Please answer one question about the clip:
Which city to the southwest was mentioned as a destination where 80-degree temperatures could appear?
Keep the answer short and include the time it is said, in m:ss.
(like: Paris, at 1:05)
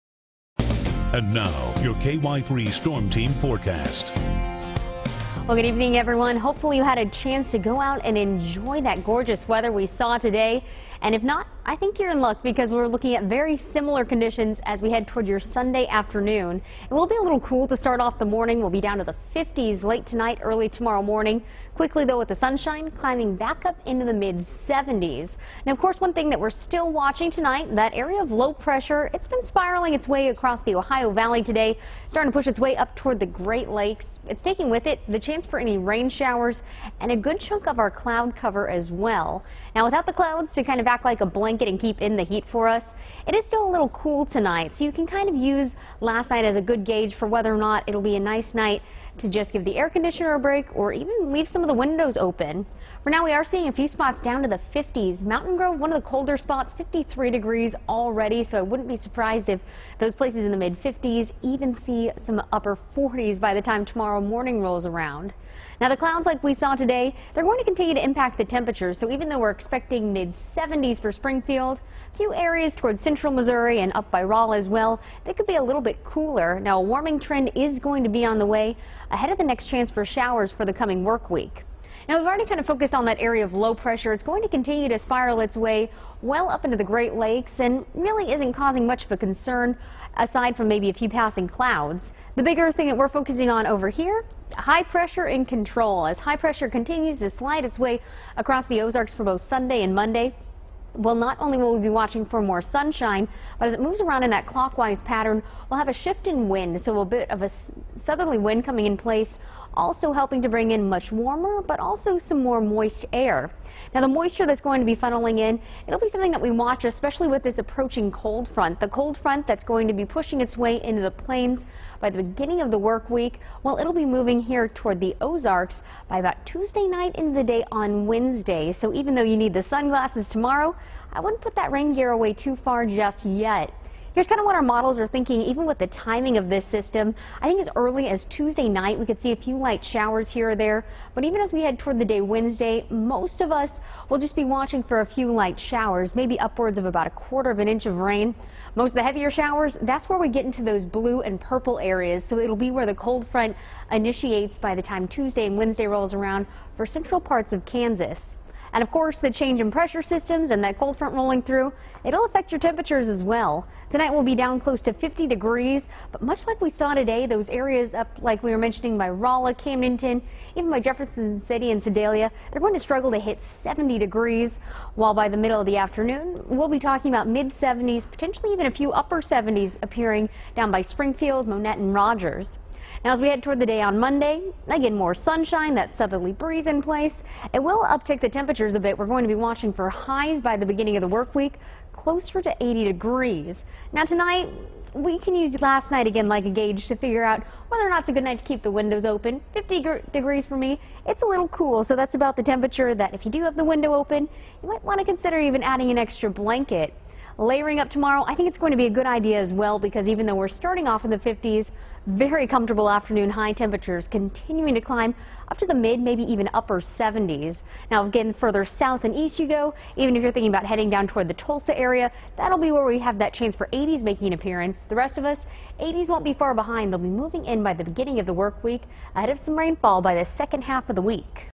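Tulsa, at 3:41.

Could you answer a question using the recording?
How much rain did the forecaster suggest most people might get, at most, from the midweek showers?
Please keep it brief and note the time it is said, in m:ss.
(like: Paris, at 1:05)
a quarter of an inch, at 2:27.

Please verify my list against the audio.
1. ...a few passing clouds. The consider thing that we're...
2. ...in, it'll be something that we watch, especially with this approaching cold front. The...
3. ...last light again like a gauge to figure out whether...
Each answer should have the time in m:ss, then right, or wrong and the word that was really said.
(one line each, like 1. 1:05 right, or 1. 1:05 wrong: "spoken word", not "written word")
1. 1:30 wrong: "bigger", not "consider"
2. 1:55 right
3. 3:15 wrong: "night", not "light".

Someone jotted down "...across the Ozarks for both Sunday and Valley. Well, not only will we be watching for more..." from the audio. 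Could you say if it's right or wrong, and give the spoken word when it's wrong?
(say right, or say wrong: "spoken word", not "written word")
wrong: "Monday", not "Valley".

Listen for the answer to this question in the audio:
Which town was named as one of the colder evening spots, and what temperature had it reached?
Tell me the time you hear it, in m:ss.
0:55.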